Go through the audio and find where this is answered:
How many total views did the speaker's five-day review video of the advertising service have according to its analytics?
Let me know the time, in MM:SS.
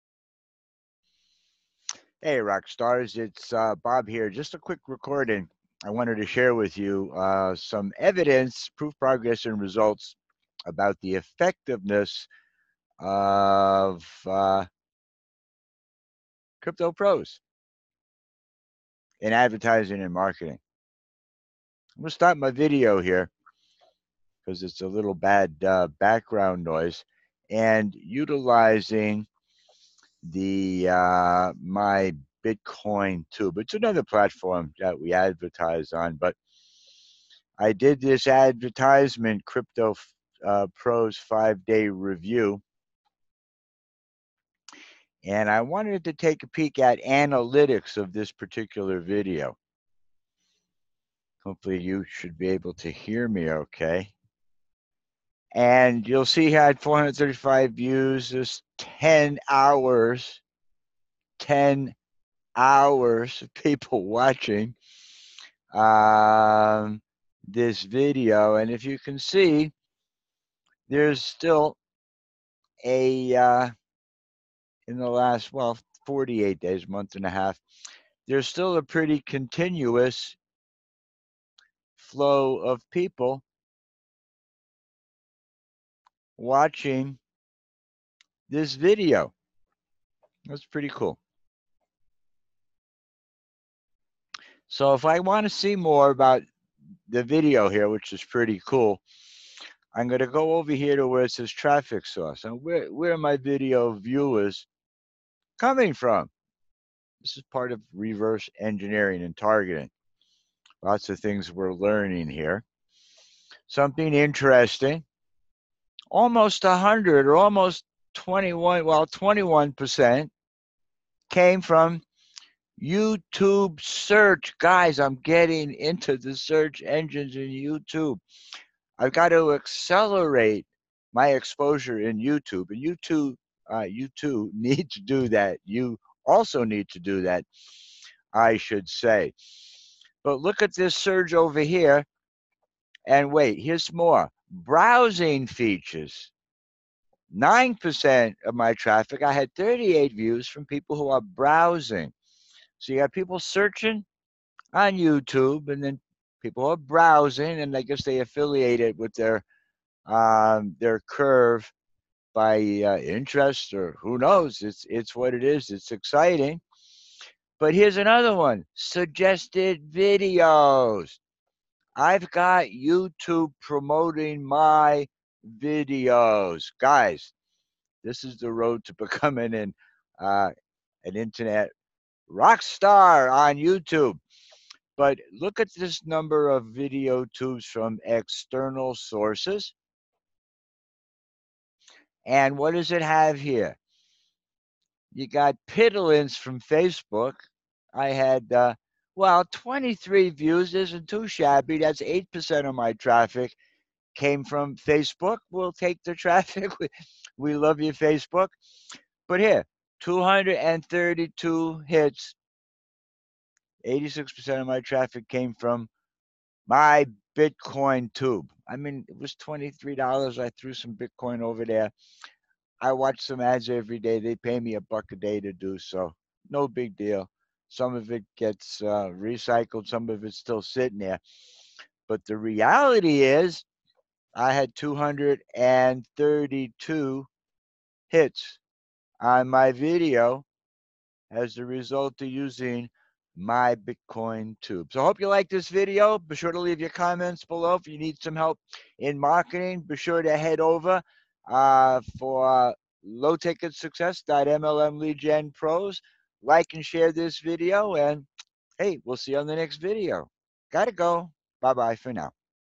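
00:56.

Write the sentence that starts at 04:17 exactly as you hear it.
And hey, we'll see you on the next video.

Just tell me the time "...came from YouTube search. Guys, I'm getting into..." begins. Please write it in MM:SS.
02:01.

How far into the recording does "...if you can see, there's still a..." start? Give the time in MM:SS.
01:08.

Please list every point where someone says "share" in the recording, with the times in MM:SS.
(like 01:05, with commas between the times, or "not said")
00:06, 04:16.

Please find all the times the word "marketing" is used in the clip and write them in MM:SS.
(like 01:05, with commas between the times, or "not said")
00:20, 04:09.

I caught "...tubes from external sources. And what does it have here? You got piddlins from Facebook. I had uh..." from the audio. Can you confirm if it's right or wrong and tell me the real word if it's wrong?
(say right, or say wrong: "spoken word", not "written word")
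right.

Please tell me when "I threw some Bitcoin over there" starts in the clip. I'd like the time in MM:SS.
03:40.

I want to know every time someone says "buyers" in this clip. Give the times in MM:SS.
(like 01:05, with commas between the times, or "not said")
not said.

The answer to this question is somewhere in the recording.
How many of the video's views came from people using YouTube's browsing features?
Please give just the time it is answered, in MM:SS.
02:29.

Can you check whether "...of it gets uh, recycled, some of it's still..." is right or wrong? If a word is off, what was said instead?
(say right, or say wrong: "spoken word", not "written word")
right.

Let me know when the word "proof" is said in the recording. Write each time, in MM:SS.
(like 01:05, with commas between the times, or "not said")
00:08.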